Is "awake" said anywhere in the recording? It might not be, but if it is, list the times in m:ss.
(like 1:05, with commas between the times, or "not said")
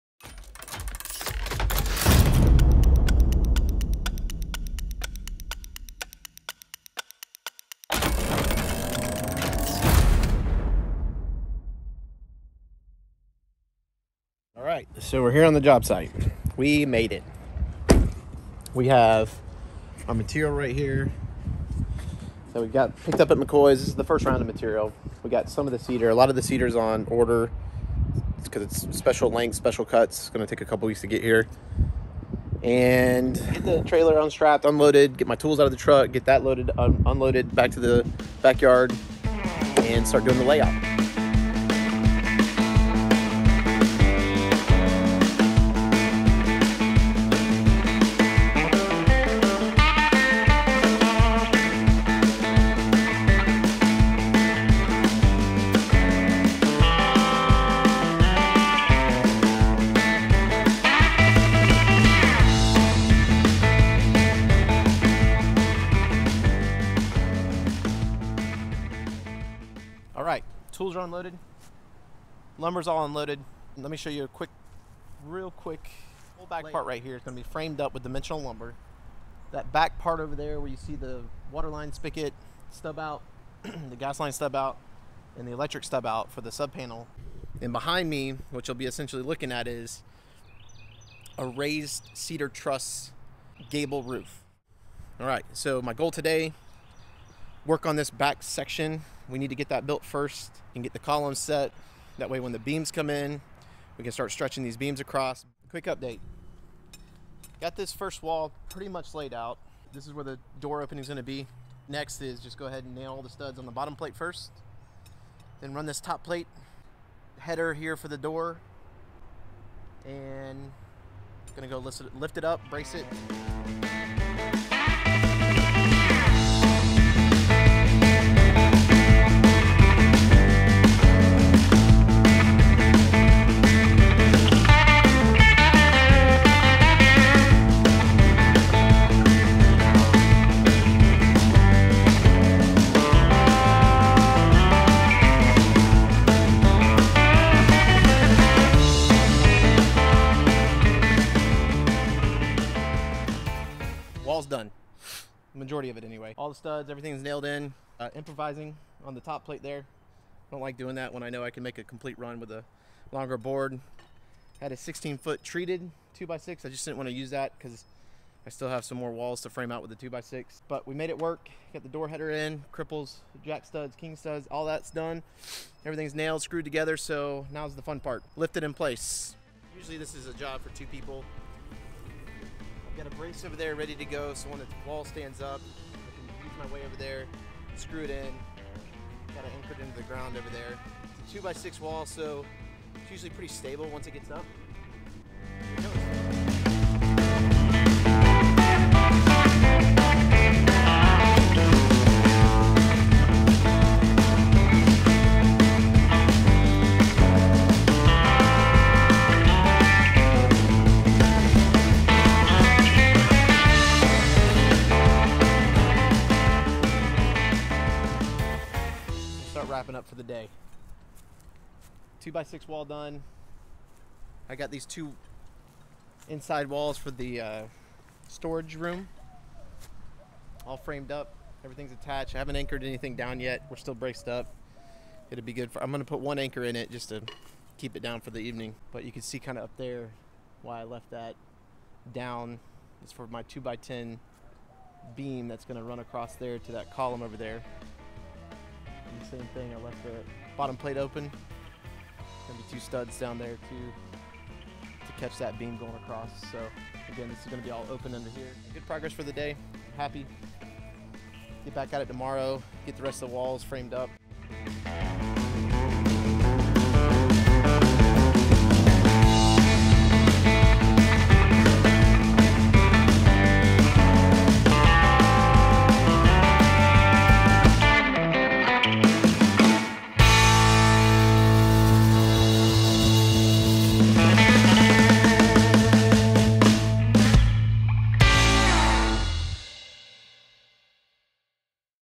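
not said.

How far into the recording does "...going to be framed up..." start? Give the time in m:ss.
1:17.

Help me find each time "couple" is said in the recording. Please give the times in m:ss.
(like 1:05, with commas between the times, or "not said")
0:30.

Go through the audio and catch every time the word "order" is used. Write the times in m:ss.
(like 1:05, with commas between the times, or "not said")
0:27.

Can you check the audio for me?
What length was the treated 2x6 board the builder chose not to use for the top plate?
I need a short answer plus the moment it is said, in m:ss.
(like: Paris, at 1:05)
16 foot, at 2:44.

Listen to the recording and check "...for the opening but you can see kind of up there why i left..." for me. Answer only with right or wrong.
wrong.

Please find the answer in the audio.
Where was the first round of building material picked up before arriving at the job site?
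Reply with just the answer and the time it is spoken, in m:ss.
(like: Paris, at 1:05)
McCoy's, at 0:23.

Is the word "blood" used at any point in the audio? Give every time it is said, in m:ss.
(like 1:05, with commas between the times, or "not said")
not said.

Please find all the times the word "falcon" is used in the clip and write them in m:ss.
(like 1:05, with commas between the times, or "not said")
not said.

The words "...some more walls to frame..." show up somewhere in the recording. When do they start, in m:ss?
2:48.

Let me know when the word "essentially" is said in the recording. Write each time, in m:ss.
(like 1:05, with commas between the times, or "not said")
1:28.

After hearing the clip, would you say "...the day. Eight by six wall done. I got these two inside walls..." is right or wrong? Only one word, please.
wrong.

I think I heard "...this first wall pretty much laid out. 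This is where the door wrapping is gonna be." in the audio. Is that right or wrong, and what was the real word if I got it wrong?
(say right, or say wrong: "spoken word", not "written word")
wrong: "opening", not "wrapping".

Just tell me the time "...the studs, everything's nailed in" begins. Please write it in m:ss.
2:36.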